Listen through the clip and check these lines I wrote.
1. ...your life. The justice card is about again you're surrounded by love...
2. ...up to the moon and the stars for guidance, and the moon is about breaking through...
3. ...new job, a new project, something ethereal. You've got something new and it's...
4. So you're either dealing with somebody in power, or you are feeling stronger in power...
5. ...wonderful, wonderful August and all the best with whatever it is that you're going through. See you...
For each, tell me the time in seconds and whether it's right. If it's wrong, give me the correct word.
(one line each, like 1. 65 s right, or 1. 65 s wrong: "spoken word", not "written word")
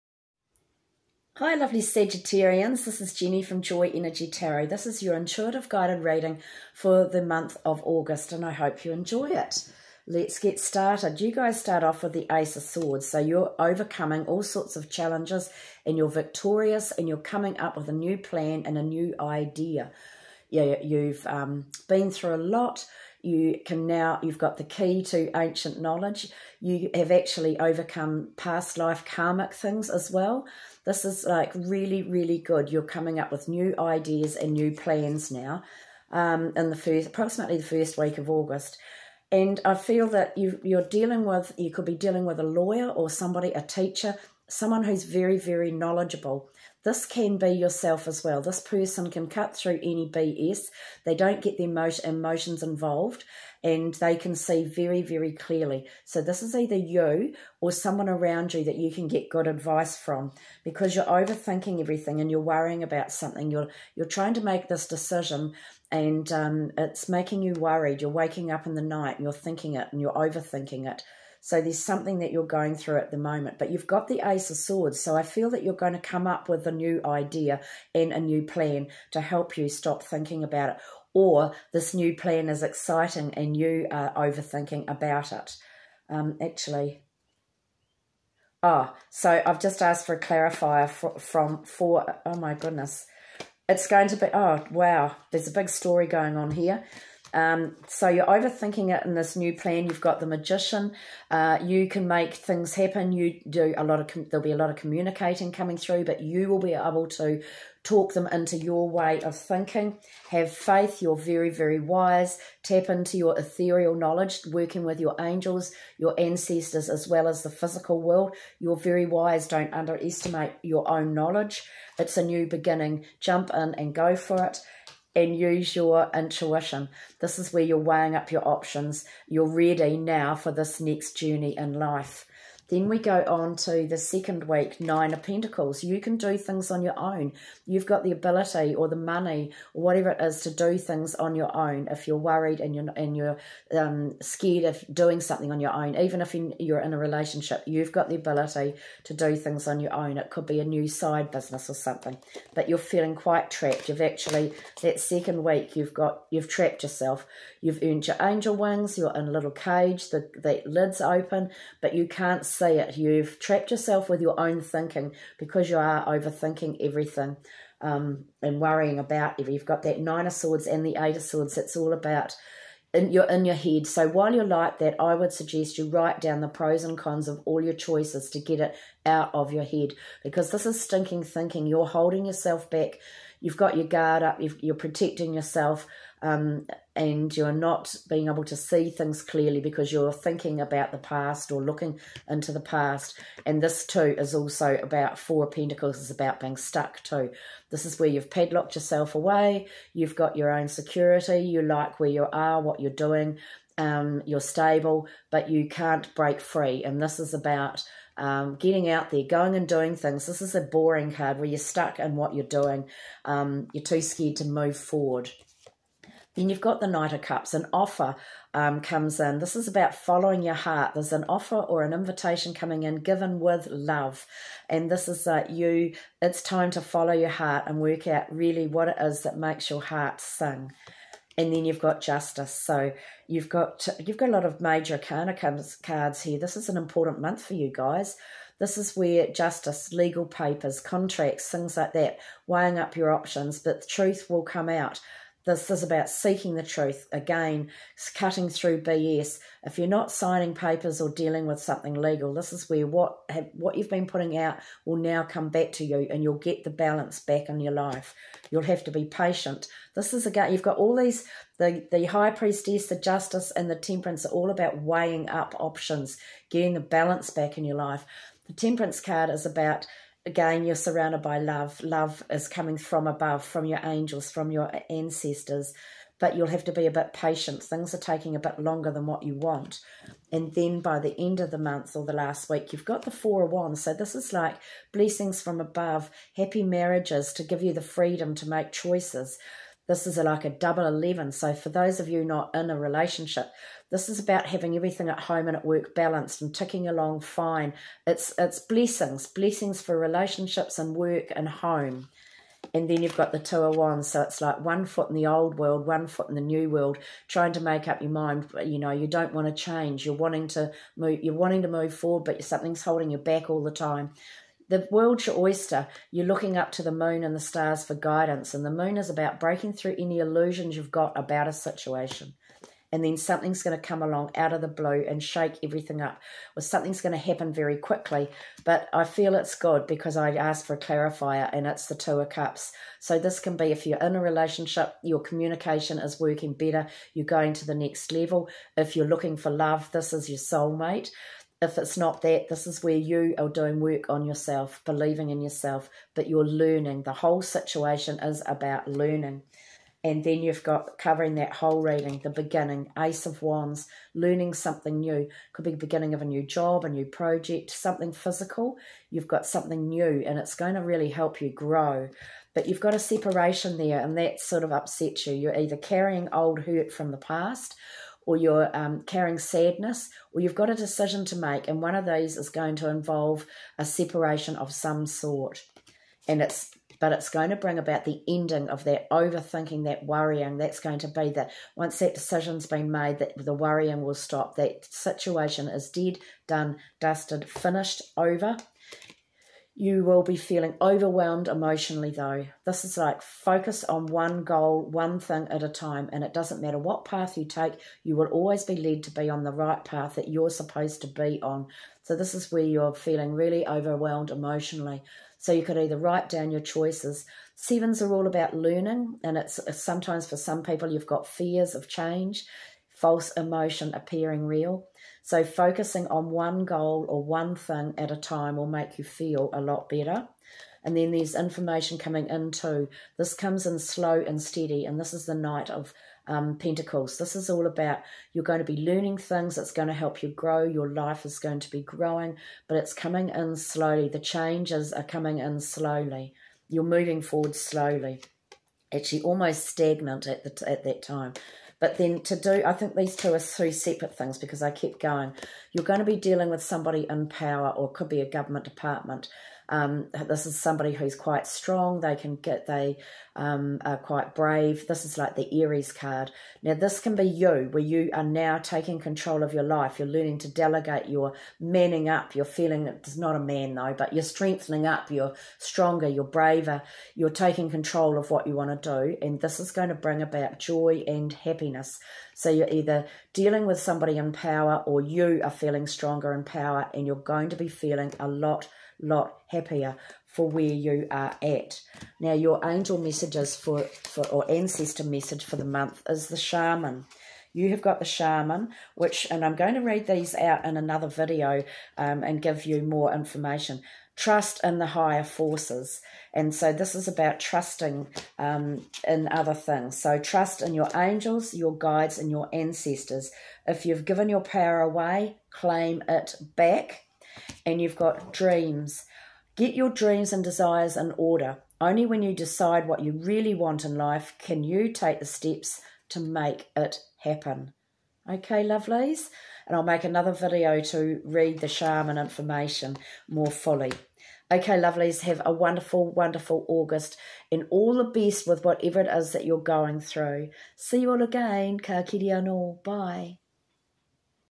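1. 267 s wrong: "temperance", not "justice"
2. 316 s right
3. 356 s wrong: "physical", not "ethereal"
4. 472 s right
5. 525 s right.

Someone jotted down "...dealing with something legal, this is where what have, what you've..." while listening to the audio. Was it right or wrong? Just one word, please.
right.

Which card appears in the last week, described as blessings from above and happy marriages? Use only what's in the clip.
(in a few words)
Four of Wands.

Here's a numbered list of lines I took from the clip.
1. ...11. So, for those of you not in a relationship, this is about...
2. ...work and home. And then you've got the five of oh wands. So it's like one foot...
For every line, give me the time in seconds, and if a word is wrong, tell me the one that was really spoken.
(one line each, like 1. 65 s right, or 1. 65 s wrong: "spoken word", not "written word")
1. 290 s right
2. 300 s wrong: "two", not "five".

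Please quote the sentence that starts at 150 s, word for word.
It could be a new side business or something, but you're feeling quite trapped.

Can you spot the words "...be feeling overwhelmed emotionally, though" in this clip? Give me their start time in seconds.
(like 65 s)
390 s.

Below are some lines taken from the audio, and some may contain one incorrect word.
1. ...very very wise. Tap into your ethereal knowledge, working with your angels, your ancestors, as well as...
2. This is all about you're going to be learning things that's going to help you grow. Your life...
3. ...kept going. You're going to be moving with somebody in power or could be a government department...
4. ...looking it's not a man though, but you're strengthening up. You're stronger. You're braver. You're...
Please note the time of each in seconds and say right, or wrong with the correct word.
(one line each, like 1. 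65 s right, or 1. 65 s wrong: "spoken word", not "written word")
1. 111 s right
2. 427 s right
3. 444 s wrong: "dealing", not "moving"
4. 462 s wrong: "feeling", not "looking".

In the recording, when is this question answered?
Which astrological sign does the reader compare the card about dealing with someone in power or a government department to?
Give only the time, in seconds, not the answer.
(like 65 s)
455 s.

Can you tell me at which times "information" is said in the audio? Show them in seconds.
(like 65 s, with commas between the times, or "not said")
421 s, 493 s, 522 s.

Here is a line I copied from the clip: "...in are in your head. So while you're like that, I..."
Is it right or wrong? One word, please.
right.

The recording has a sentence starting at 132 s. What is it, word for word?
Then we go on to the second week, Nine of Pentacles.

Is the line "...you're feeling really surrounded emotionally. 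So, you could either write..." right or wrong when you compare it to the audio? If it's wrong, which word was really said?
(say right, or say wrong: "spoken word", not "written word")
wrong: "overwhelmed", not "surrounded".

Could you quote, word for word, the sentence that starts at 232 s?
So you've got you've got a lot of major arcana cards here.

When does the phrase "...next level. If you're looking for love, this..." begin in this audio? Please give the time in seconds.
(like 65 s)
337 s.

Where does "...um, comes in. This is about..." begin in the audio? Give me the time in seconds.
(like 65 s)
218 s.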